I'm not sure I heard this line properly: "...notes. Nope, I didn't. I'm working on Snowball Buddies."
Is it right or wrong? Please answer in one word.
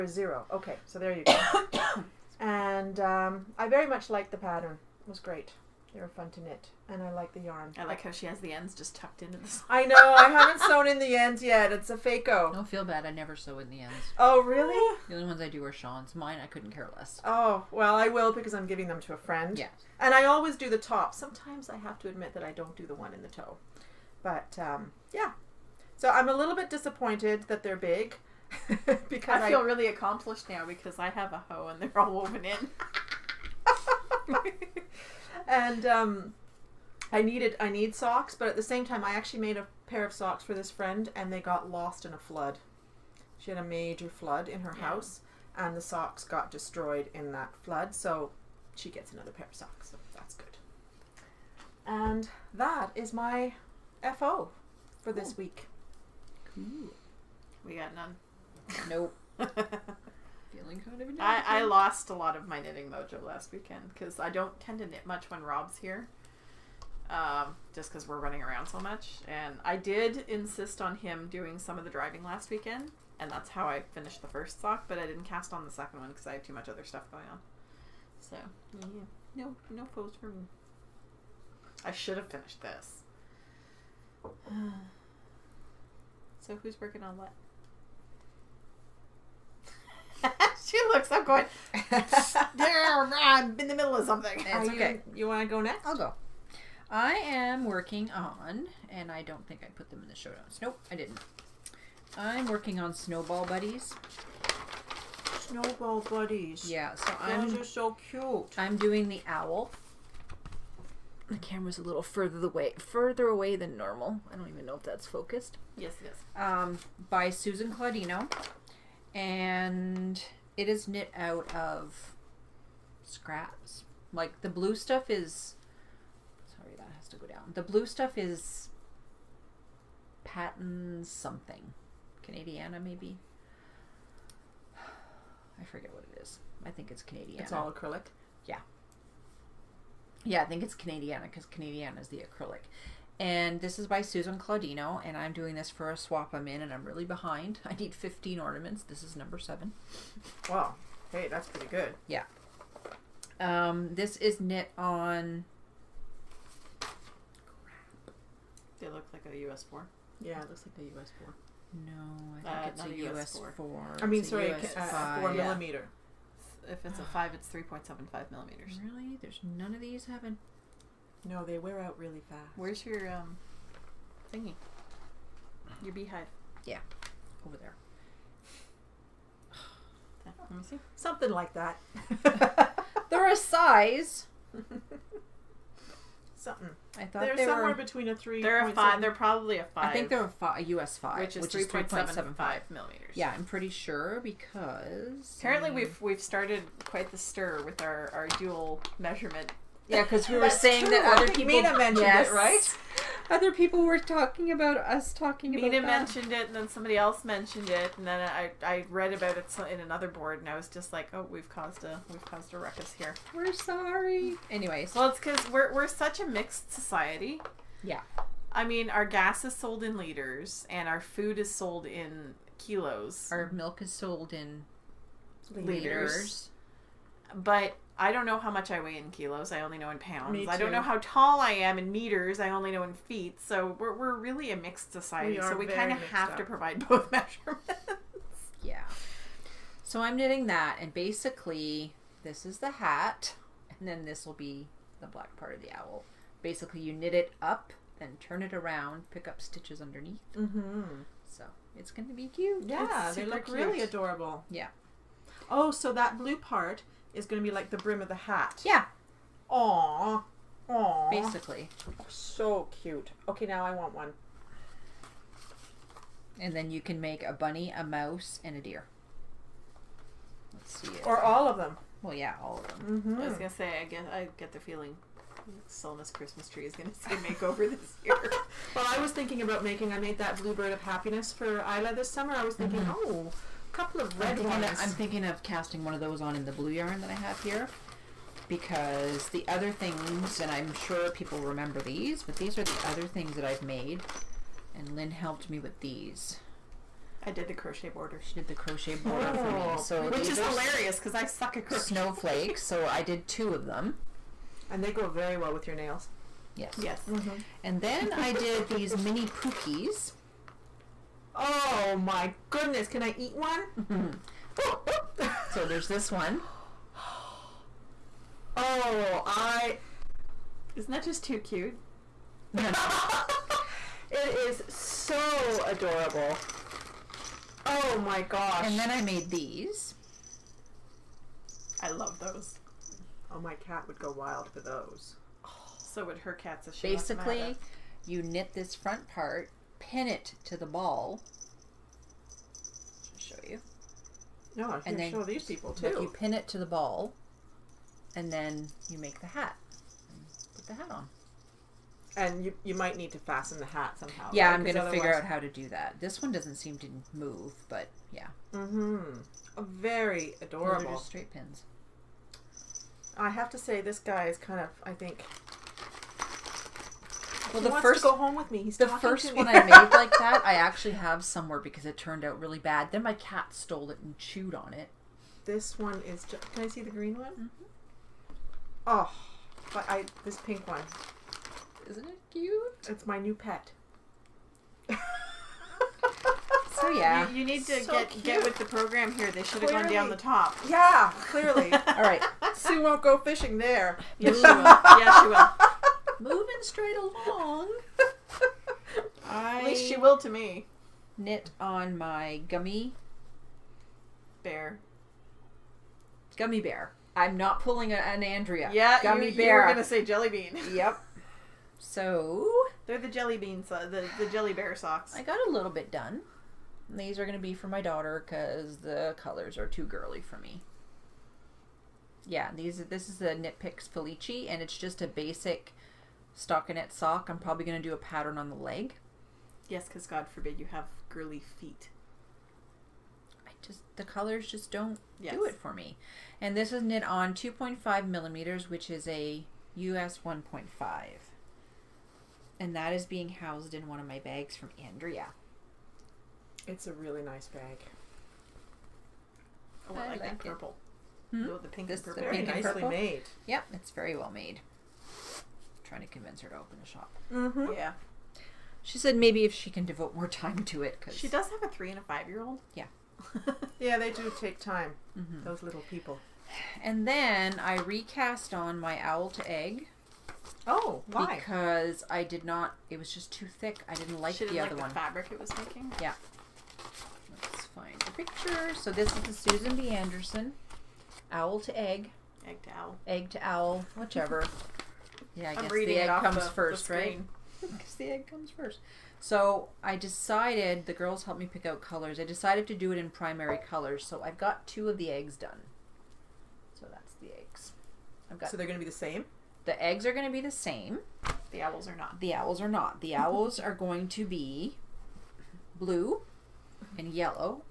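right.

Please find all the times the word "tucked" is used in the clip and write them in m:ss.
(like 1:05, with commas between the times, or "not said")
0:08.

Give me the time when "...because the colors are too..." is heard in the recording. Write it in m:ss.
6:58.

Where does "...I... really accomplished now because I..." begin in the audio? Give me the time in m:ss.
0:29.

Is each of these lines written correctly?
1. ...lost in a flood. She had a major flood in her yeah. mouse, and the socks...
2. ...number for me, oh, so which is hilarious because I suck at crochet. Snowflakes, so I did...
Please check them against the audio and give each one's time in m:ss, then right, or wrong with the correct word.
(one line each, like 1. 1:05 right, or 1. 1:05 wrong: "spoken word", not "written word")
1. 0:41 wrong: "house", not "mouse"
2. 4:58 wrong: "border", not "number".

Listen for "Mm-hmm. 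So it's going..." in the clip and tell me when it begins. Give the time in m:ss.
4:10.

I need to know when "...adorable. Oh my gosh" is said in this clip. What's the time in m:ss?
5:25.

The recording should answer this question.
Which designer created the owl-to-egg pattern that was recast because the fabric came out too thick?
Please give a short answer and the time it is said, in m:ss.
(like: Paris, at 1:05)
Susan B. Anderson, at 7:59.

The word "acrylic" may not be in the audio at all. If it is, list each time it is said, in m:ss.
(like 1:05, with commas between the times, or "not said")
2:17, 2:22.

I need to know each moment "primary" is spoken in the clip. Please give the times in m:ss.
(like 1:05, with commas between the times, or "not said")
8:13.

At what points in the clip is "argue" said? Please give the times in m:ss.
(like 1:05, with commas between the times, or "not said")
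not said.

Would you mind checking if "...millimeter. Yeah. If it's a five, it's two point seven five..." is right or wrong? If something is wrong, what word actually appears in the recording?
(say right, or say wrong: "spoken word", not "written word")
wrong: "three", not "two".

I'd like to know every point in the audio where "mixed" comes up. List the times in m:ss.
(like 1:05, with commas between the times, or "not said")
3:36, 3:54.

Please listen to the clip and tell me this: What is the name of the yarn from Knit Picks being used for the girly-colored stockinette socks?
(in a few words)
Felici.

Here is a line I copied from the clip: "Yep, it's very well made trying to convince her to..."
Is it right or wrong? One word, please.
right.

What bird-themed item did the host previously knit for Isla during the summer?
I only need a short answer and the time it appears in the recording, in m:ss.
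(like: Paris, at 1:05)
Bluebird of happiness, at 4:40.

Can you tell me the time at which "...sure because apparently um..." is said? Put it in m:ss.
3:13.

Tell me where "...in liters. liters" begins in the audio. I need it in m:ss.
3:44.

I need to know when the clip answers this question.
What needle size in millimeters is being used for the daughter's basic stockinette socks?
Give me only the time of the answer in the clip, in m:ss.
7:17.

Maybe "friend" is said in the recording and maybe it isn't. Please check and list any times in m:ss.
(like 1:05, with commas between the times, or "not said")
0:19, 0:40.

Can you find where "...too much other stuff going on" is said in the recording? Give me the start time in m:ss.
1:16.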